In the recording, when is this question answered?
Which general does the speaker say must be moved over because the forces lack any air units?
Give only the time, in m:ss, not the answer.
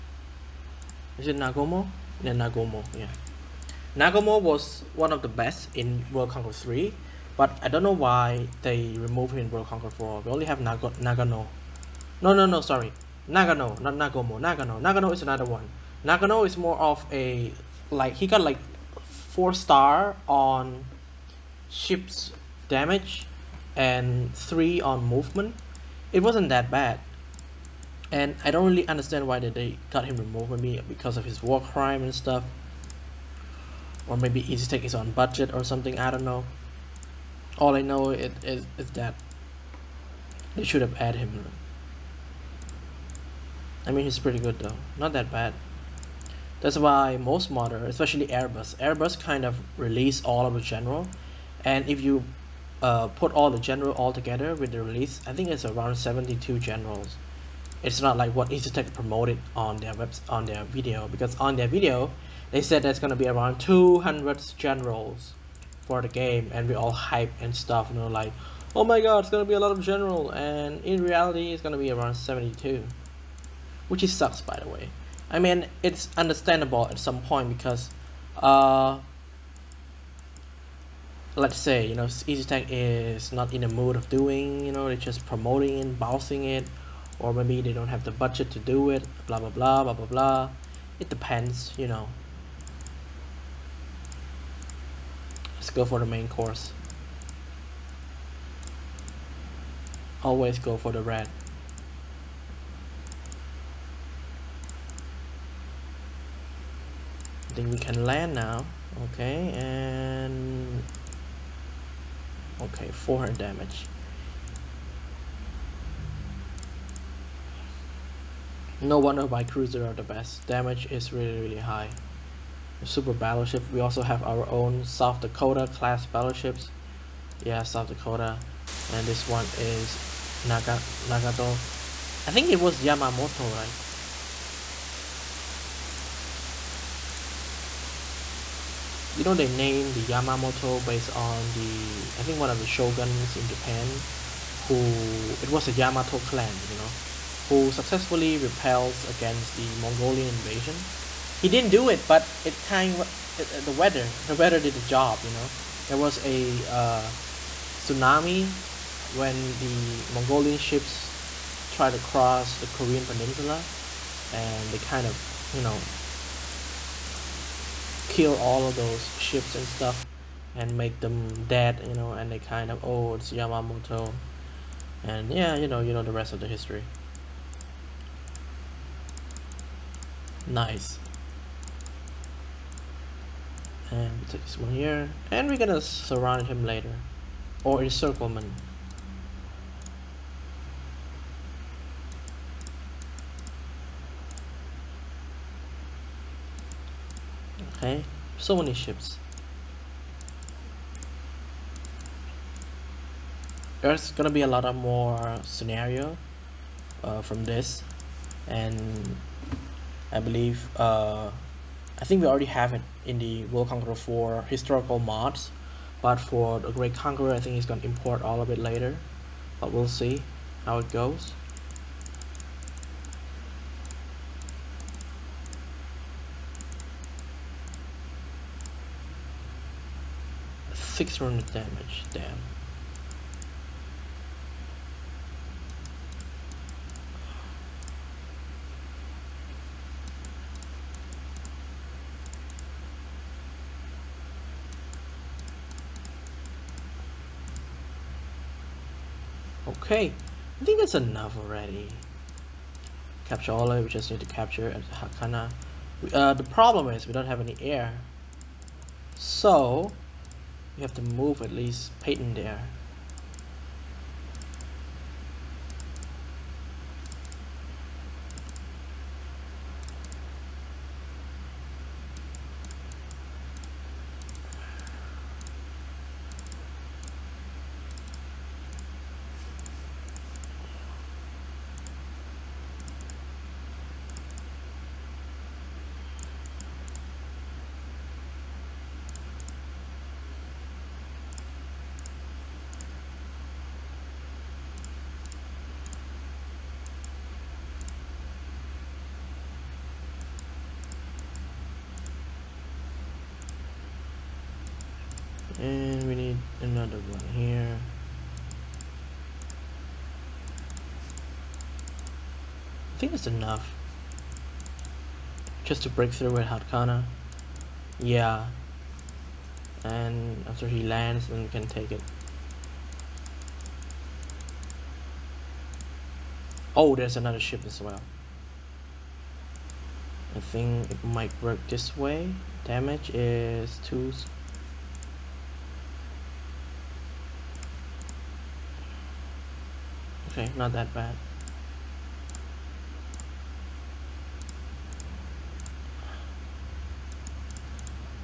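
4:21.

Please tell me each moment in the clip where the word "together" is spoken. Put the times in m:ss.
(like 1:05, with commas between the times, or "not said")
0:54.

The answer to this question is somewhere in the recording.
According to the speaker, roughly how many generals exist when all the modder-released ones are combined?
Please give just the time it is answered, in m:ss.
0:55.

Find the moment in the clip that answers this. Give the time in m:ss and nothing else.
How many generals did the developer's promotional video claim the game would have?
1:03.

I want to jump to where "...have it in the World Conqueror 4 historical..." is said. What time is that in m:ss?
3:32.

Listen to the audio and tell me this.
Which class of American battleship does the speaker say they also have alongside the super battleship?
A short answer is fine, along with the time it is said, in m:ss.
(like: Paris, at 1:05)
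South Dakota class, at 2:04.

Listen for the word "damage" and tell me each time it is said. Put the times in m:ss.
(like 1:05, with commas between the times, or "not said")
0:22, 1:53, 2:00, 3:51, 5:32.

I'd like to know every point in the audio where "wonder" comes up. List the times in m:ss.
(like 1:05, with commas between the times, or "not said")
1:58.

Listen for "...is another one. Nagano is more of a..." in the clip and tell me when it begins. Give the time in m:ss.
0:15.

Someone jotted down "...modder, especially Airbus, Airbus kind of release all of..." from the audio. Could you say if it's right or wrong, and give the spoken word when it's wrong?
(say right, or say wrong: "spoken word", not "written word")
right.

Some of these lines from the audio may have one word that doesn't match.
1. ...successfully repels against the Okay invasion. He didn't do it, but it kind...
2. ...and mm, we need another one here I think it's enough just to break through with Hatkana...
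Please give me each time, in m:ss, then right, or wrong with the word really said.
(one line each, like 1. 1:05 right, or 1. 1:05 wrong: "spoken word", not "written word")
1. 2:27 wrong: "Mongolian", not "Okay"
2. 5:05 right.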